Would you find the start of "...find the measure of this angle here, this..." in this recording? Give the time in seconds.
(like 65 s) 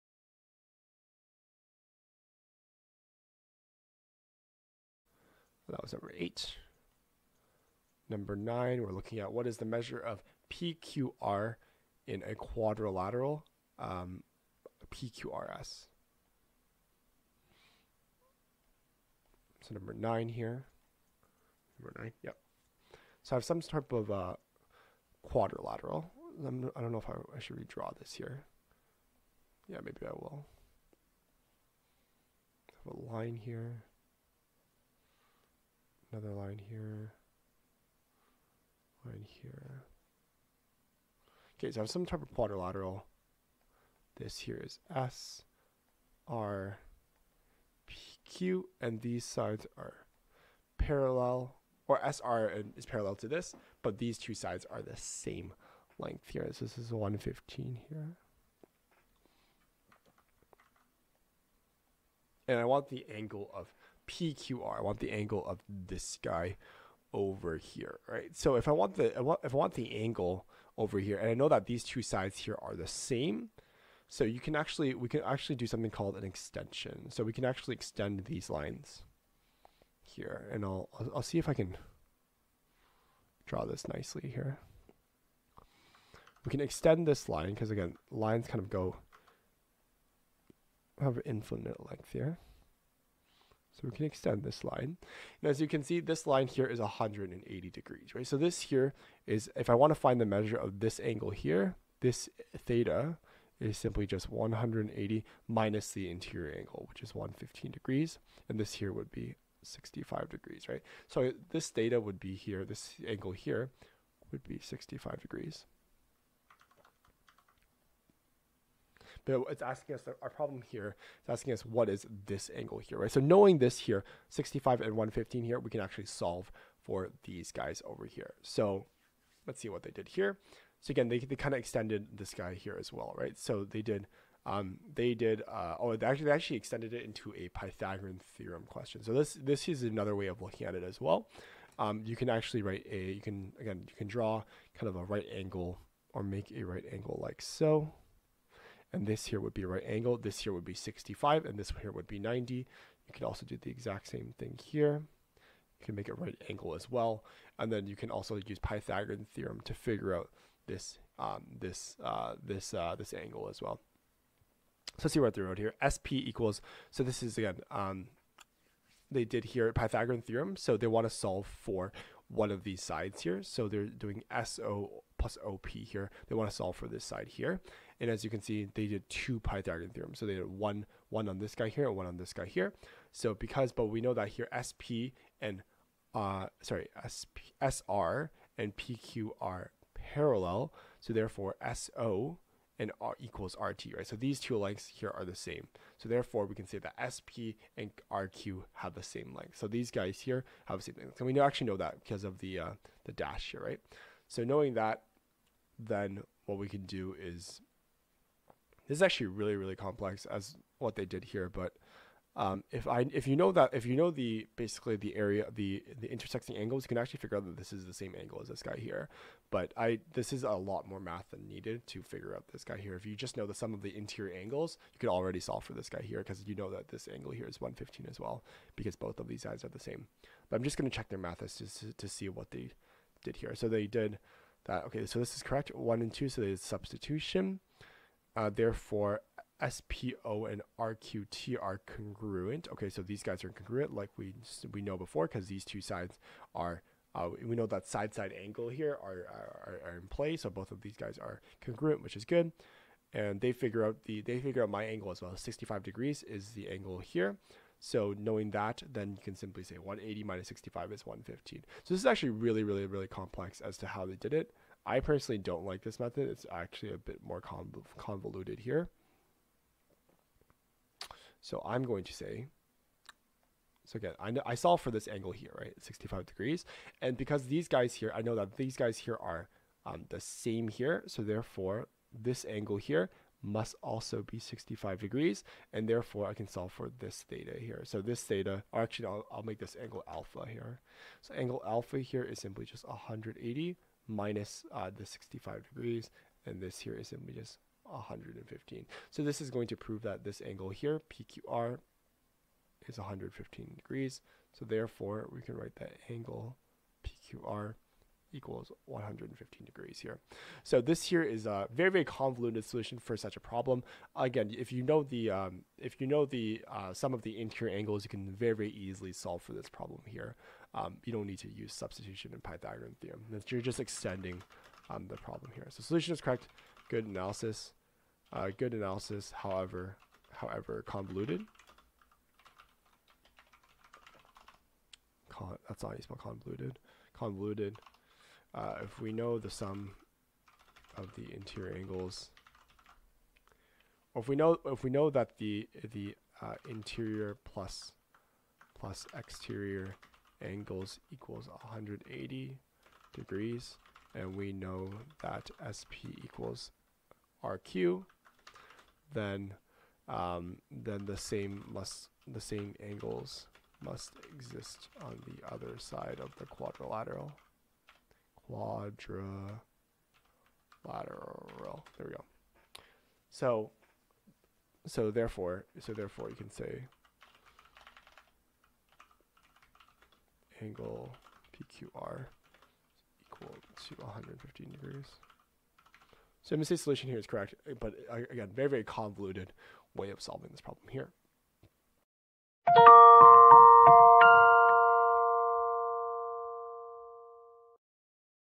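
99 s.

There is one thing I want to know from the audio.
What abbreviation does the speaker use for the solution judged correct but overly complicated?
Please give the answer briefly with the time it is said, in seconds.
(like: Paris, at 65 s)
MSA, at 386 s.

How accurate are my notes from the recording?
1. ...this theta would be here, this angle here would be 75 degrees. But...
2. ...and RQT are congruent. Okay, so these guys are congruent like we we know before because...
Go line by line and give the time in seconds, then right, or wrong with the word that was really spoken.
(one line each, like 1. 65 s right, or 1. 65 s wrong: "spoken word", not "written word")
1. 111 s wrong: "65", not "75"
2. 240 s right.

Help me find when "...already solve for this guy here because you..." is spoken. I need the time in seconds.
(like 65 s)
225 s.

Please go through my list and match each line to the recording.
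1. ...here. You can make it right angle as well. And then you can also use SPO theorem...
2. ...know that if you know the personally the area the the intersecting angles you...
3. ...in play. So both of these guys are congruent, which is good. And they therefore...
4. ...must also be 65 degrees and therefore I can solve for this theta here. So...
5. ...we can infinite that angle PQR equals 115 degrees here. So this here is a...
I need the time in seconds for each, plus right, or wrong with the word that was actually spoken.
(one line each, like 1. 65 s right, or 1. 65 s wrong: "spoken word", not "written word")
1. 154 s wrong: "Pythagorean", not "SPO"
2. 213 s wrong: "basically", not "personally"
3. 250 s wrong: "figure", not "therefore"
4. 283 s right
5. 305 s wrong: "write", not "infinite".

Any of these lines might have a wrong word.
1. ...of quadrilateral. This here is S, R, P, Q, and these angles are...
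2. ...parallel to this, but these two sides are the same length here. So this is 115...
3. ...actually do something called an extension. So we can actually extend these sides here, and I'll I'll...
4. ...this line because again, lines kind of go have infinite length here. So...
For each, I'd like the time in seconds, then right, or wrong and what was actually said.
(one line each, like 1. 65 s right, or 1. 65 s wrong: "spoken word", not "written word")
1. 42 s wrong: "sides", not "angles"
2. 52 s right
3. 75 s wrong: "lines", not "sides"
4. 87 s right.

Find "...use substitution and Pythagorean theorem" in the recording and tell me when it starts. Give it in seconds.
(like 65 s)
321 s.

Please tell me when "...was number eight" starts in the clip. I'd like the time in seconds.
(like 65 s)
5 s.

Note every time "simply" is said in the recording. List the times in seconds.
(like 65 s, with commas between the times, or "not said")
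103 s, 259 s, 292 s, 297 s.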